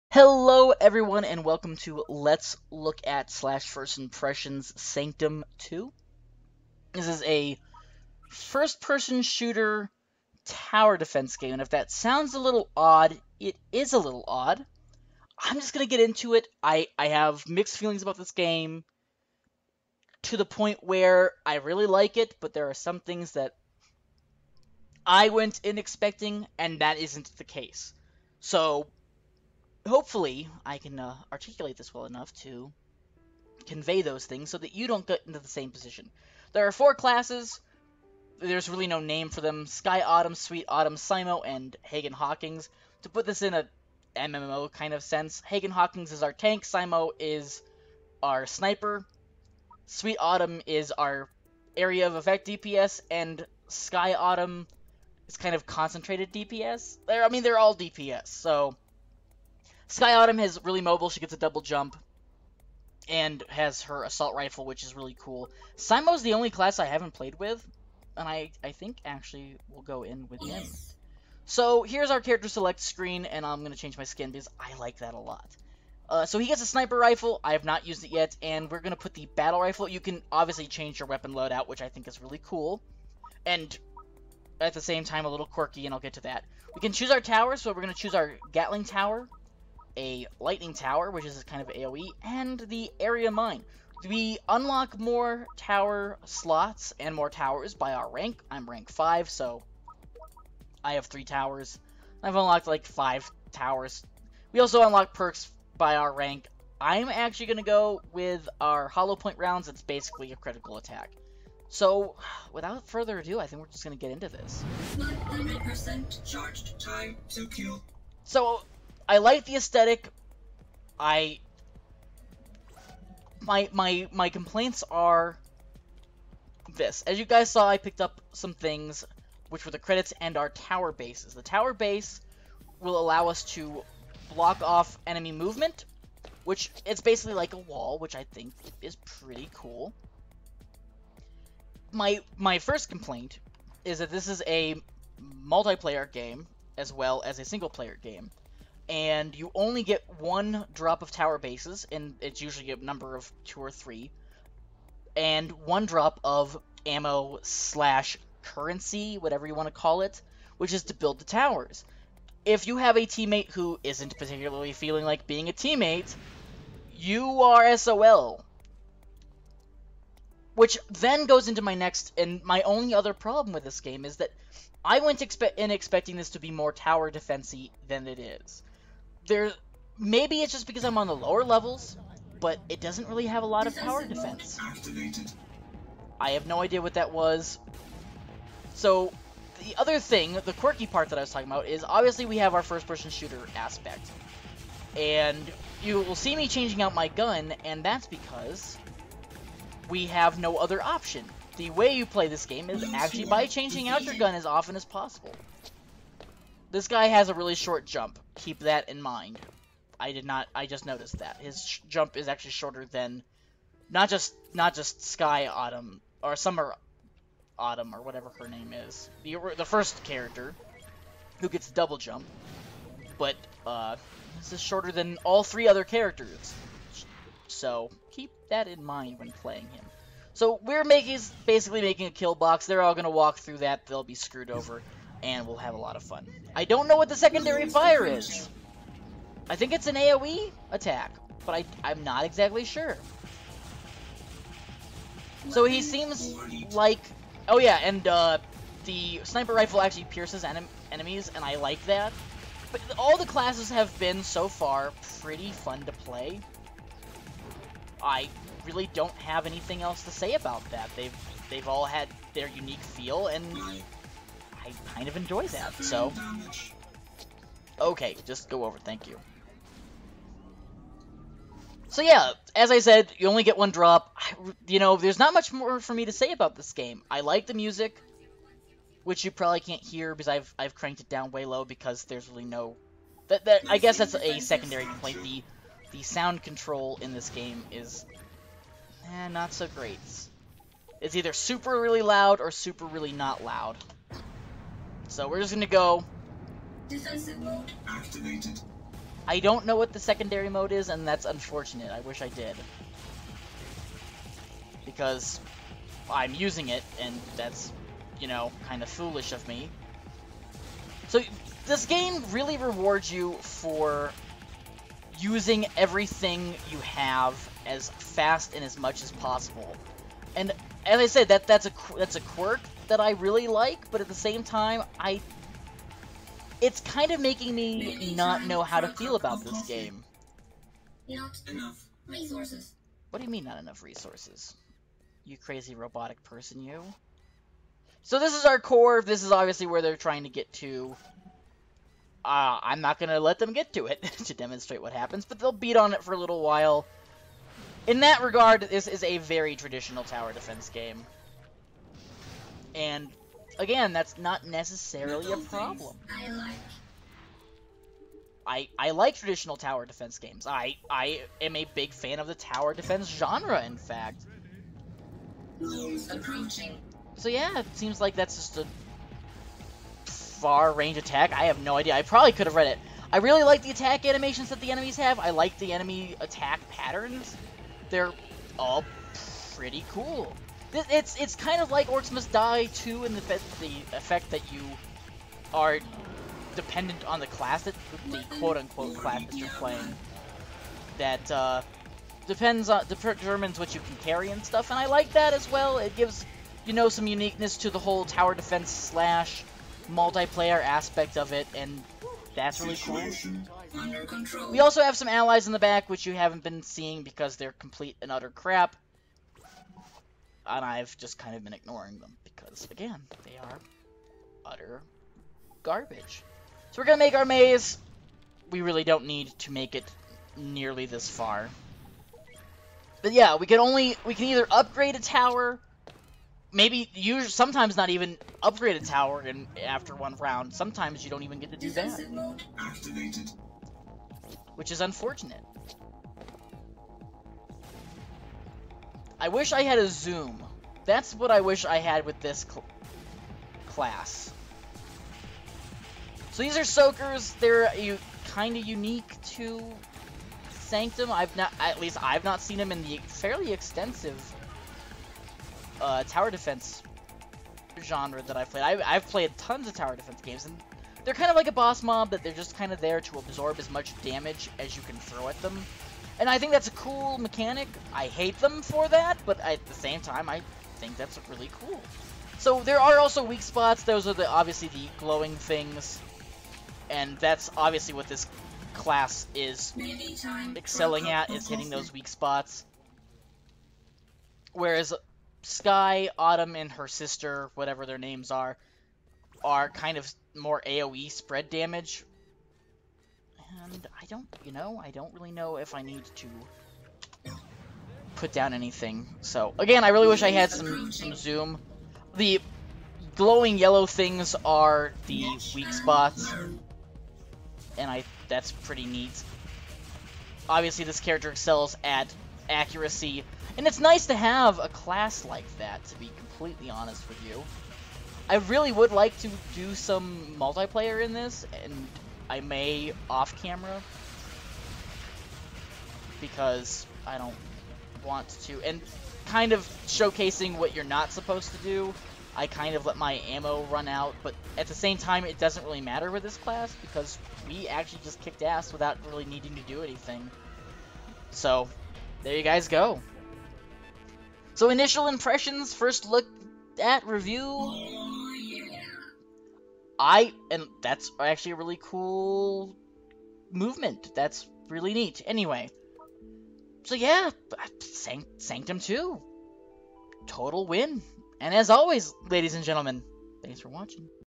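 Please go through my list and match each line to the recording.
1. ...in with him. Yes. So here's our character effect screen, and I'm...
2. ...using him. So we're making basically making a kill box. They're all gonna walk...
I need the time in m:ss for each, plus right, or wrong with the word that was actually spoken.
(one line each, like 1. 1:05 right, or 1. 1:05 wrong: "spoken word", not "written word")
1. 1:10 wrong: "select", not "effect"
2. 3:49 wrong: "playing", not "using".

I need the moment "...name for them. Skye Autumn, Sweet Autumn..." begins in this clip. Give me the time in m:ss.
0:38.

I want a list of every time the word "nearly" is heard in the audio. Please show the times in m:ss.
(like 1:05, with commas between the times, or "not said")
7:00.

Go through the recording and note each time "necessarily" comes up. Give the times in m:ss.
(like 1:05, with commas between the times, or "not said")
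5:54.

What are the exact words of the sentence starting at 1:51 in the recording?
So, without further ado, I think we're just going to get into this.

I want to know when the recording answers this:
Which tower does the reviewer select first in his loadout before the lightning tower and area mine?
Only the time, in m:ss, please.
1:28.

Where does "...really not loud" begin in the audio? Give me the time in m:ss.
4:52.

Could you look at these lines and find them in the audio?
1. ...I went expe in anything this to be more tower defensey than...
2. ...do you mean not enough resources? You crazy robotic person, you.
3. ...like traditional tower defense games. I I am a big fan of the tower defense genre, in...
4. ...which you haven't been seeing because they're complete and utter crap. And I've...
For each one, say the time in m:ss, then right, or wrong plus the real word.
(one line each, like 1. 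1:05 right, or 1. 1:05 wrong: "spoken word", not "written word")
1. 2:54 wrong: "expecting", not "anything"
2. 5:33 right
3. 5:58 right
4. 6:45 right.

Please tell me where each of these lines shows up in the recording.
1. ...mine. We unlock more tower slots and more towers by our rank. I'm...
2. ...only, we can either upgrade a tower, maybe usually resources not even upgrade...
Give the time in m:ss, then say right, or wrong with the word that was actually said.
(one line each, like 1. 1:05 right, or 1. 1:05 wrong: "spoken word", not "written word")
1. 1:33 right
2. 7:03 wrong: "sometimes", not "resources".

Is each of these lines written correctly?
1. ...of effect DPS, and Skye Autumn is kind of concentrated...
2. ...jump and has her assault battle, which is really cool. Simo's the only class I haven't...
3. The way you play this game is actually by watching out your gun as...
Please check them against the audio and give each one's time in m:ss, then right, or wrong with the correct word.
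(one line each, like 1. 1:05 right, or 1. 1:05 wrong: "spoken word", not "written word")
1. 0:52 right
2. 1:01 wrong: "rifle", not "battle"
3. 3:21 wrong: "changing", not "watching".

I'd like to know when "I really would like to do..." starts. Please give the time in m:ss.
8:38.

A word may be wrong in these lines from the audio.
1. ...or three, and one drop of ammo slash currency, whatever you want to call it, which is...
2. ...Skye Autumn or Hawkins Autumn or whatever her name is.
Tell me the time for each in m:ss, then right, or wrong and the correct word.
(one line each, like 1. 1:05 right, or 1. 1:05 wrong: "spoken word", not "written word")
1. 2:33 right
2. 3:35 wrong: "Summer", not "Hawkins".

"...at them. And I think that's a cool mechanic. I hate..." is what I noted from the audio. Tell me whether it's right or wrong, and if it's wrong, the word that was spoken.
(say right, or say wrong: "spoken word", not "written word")
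right.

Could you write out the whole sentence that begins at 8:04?
Whereas Skye, Autumn, and her sister, whatever their names are, are kind of more AoE spread damage.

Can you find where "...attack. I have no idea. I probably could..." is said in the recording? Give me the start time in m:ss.
6:10.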